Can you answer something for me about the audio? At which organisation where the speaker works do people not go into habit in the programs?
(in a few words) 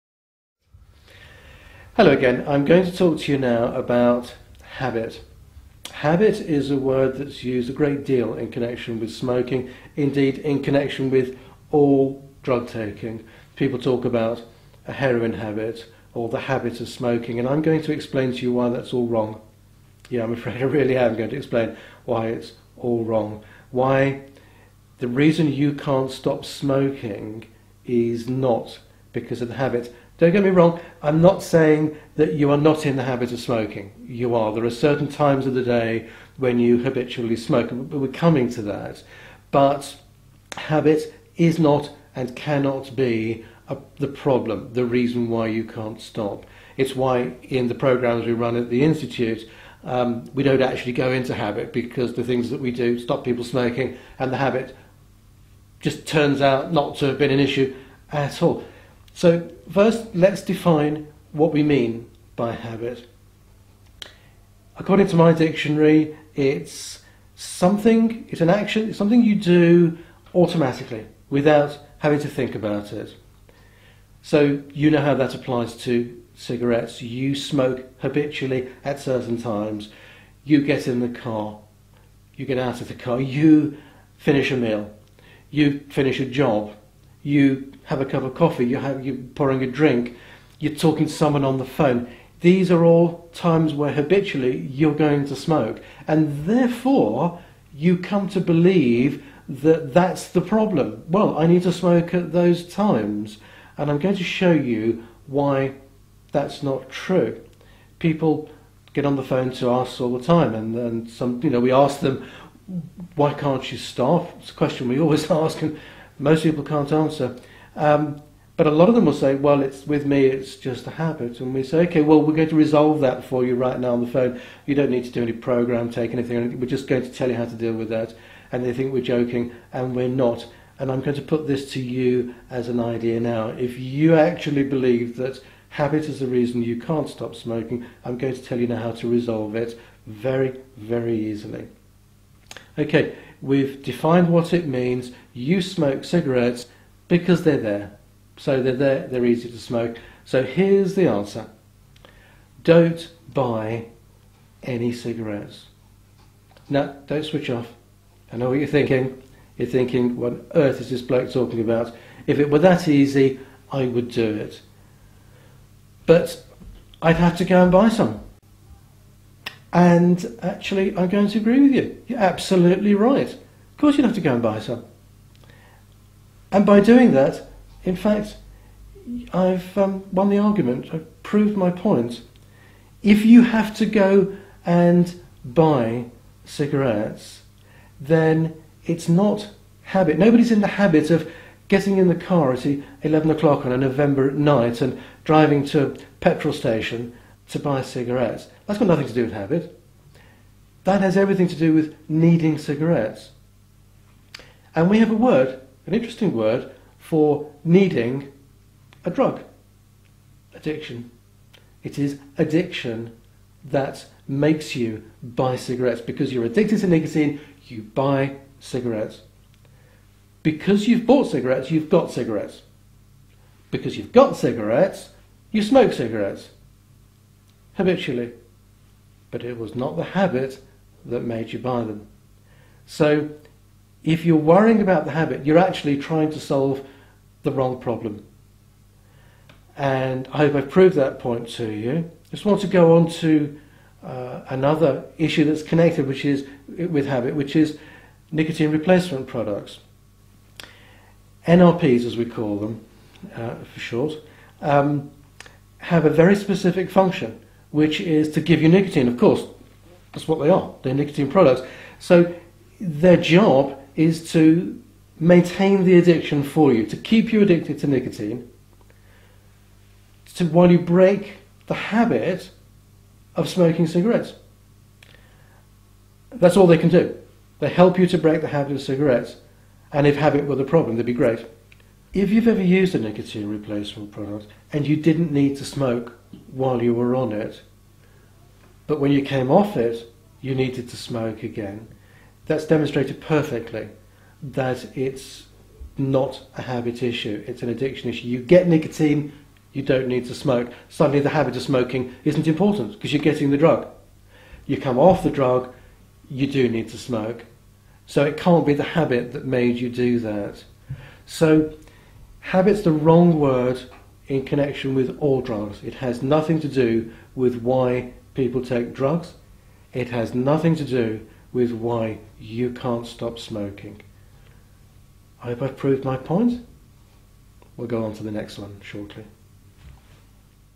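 the Institute.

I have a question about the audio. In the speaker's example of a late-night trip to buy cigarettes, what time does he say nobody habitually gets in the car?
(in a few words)
11 o'clock.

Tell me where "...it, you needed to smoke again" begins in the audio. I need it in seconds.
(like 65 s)
289 s.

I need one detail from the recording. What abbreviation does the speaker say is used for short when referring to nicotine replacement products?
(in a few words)
NRPs.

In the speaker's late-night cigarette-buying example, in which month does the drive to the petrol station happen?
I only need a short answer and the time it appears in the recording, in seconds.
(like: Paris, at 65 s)
November, at 193 s.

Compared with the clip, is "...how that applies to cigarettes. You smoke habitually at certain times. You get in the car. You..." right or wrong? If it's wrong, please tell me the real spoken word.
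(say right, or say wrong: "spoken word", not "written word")
right.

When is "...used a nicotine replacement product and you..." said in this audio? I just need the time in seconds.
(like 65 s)
282 s.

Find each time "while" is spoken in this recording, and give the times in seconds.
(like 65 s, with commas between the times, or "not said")
270 s, 286 s.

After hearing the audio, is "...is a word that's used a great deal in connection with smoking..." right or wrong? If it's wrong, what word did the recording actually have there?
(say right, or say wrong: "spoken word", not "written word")
right.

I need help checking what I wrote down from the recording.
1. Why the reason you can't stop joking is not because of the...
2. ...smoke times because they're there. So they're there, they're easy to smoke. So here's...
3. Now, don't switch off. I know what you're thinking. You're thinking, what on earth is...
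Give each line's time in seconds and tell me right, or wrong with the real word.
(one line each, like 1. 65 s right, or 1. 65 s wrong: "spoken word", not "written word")
1. 23 s wrong: "smoking", not "joking"
2. 145 s wrong: "cigarettes", not "times"
3. 156 s right.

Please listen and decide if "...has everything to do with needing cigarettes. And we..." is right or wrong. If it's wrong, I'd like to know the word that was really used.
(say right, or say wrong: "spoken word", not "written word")
right.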